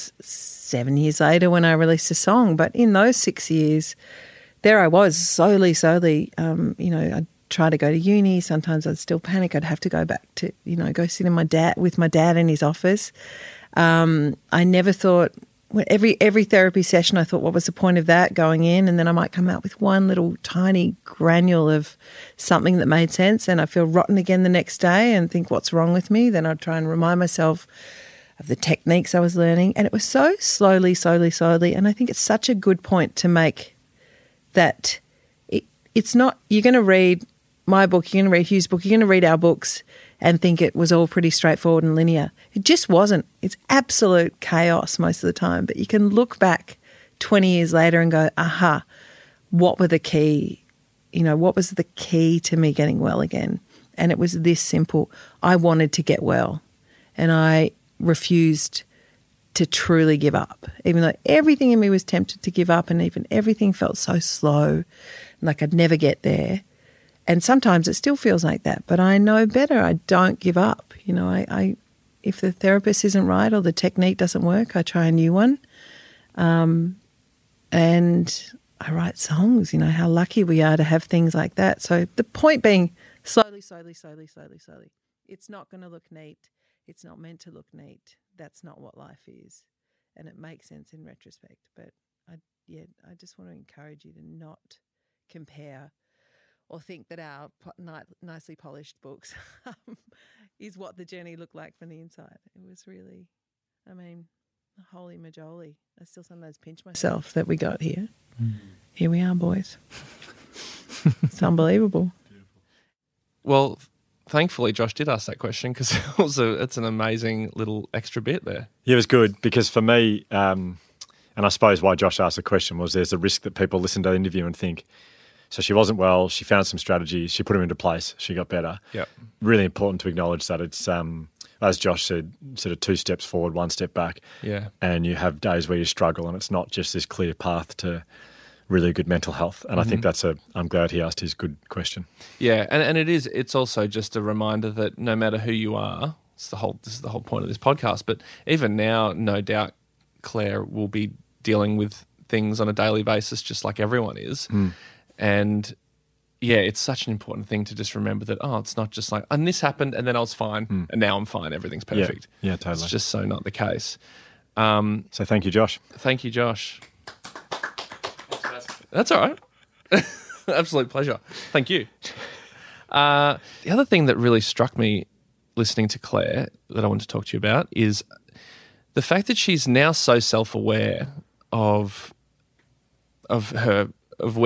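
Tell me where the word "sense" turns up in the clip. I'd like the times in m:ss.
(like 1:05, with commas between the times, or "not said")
0:23, 1:30.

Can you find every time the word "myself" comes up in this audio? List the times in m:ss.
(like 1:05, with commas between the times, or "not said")
0:27, 1:46.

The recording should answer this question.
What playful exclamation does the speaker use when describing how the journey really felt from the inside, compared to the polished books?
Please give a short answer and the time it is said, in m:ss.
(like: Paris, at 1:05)
holy majoli, at 1:44.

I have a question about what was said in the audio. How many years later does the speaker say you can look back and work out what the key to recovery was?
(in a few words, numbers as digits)
20.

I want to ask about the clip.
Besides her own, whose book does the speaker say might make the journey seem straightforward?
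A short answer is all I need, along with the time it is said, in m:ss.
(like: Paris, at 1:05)
Hugh's, at 0:38.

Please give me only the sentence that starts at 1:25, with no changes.
It's not going to look neat.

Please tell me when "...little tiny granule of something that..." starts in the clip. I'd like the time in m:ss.
0:20.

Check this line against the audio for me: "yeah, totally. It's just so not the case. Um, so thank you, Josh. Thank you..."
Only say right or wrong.
right.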